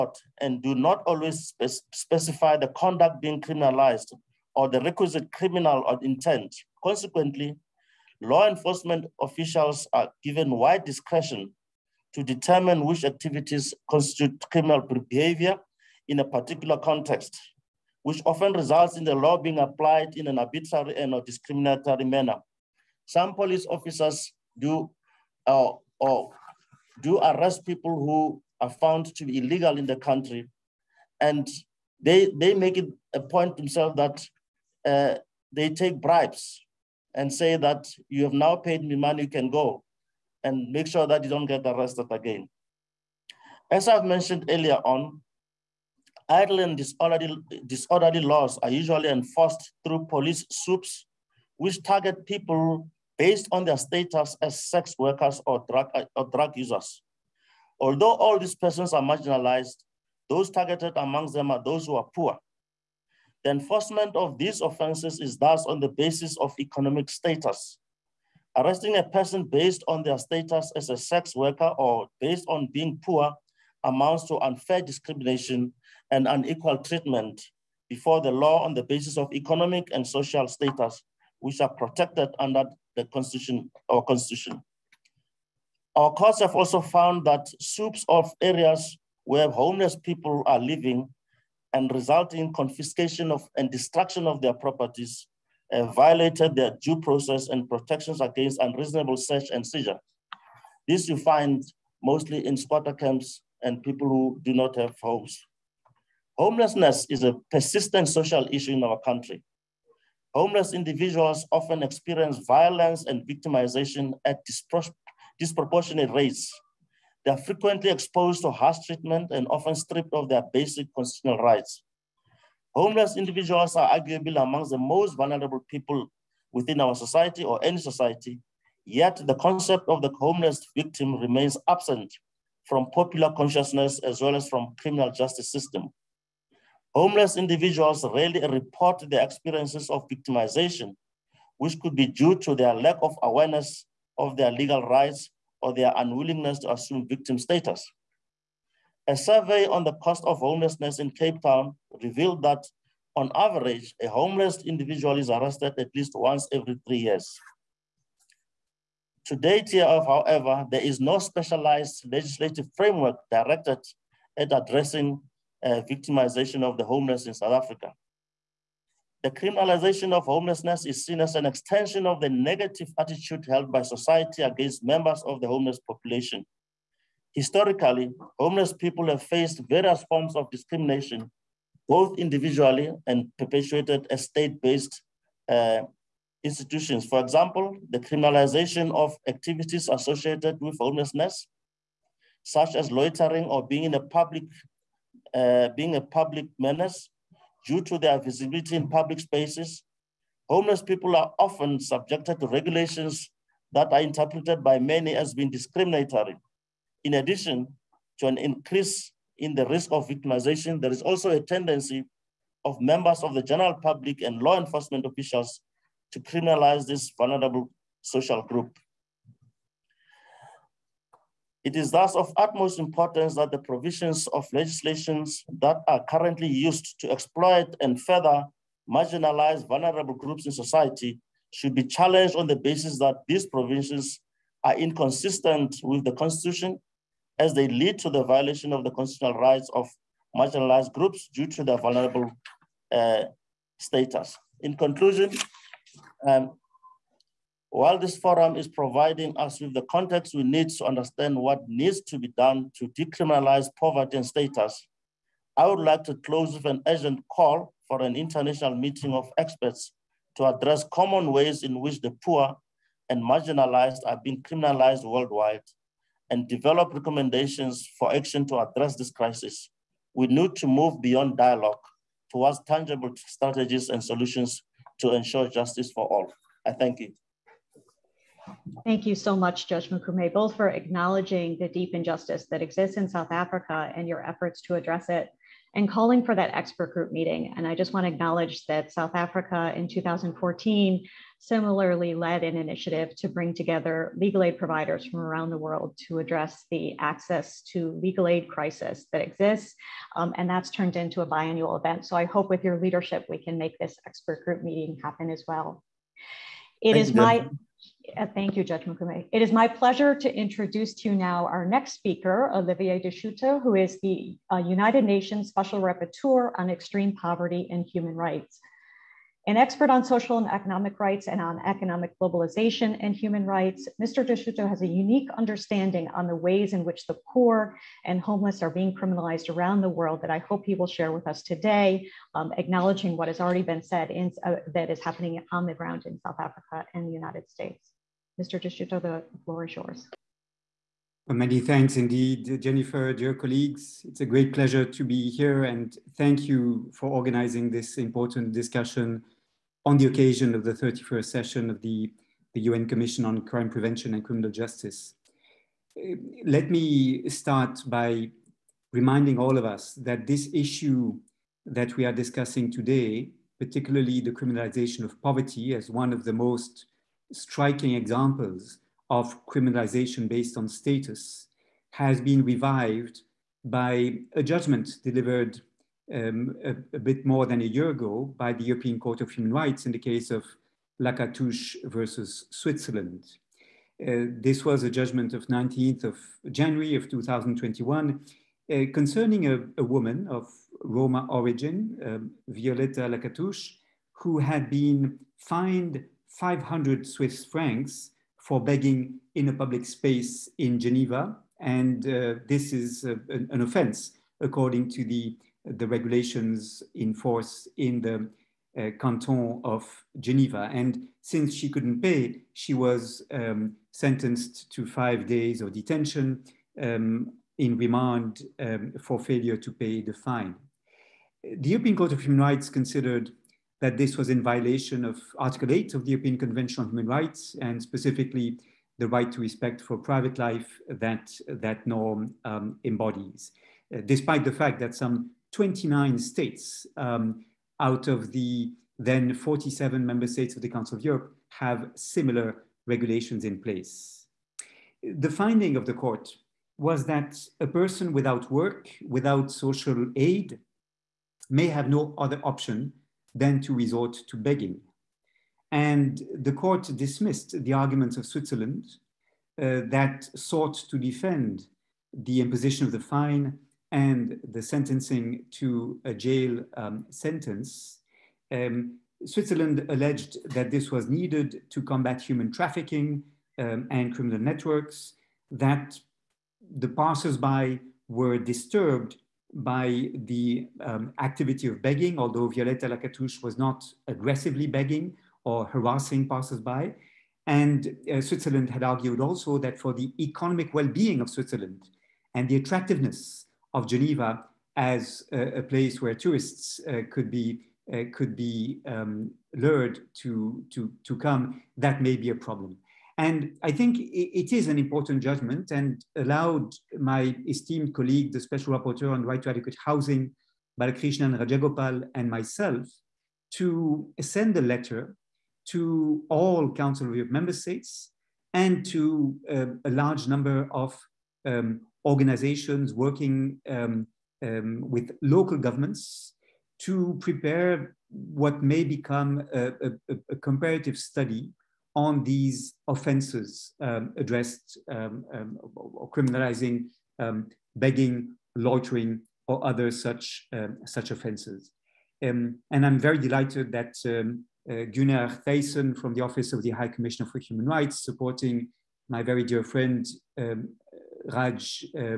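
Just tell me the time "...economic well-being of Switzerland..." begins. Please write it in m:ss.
8:10.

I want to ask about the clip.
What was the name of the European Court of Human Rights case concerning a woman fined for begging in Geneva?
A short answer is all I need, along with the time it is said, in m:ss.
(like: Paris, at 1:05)
Lacatus versus Switzerland, at 6:21.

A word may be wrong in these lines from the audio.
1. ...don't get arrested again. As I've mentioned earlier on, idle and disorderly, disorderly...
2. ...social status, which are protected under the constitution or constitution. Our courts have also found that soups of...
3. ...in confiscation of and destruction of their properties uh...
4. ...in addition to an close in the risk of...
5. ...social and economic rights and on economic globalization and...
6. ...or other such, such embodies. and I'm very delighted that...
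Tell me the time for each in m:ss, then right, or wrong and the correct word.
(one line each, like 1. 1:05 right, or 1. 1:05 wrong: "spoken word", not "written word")
1. 0:41 right
2. 1:20 right
3. 1:32 right
4. 3:27 wrong: "increase", not "close"
5. 5:20 right
6. 8:59 wrong: "offenses", not "embodies".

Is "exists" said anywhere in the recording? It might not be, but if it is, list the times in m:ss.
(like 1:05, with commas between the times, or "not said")
4:42, 4:59.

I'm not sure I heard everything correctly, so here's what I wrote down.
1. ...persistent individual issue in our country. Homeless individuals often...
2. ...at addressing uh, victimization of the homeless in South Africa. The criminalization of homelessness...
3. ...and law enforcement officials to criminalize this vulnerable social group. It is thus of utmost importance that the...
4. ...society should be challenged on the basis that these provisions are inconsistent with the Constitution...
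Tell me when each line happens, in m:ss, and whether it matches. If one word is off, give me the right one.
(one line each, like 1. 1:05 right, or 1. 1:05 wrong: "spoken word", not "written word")
1. 1:47 wrong: "social", not "individual"
2. 2:44 right
3. 3:34 right
4. 3:50 right.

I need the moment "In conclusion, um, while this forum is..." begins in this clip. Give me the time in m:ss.
4:04.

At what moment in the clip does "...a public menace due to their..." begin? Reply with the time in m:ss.
3:15.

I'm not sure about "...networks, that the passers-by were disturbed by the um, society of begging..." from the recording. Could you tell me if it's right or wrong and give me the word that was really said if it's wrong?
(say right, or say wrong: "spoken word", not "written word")
wrong: "activity", not "society".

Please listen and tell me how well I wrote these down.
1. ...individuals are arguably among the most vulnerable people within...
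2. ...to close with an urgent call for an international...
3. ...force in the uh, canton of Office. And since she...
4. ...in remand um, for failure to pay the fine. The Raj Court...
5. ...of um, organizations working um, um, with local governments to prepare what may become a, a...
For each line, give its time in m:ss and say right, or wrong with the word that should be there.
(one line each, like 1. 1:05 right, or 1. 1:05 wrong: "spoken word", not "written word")
1. 2:03 right
2. 4:16 right
3. 6:47 wrong: "Geneva", not "Office"
4. 6:57 wrong: "European", not "Raj"
5. 8:40 right.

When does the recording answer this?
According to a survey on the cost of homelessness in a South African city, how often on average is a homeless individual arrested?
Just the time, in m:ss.
2:36.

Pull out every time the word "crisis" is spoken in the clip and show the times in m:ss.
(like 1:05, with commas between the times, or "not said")
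4:29, 4:58.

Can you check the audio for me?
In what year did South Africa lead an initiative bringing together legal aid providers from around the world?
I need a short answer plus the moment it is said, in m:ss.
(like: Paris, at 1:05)
2014, at 4:49.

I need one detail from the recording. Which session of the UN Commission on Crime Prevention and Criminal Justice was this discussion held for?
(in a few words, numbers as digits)
31st.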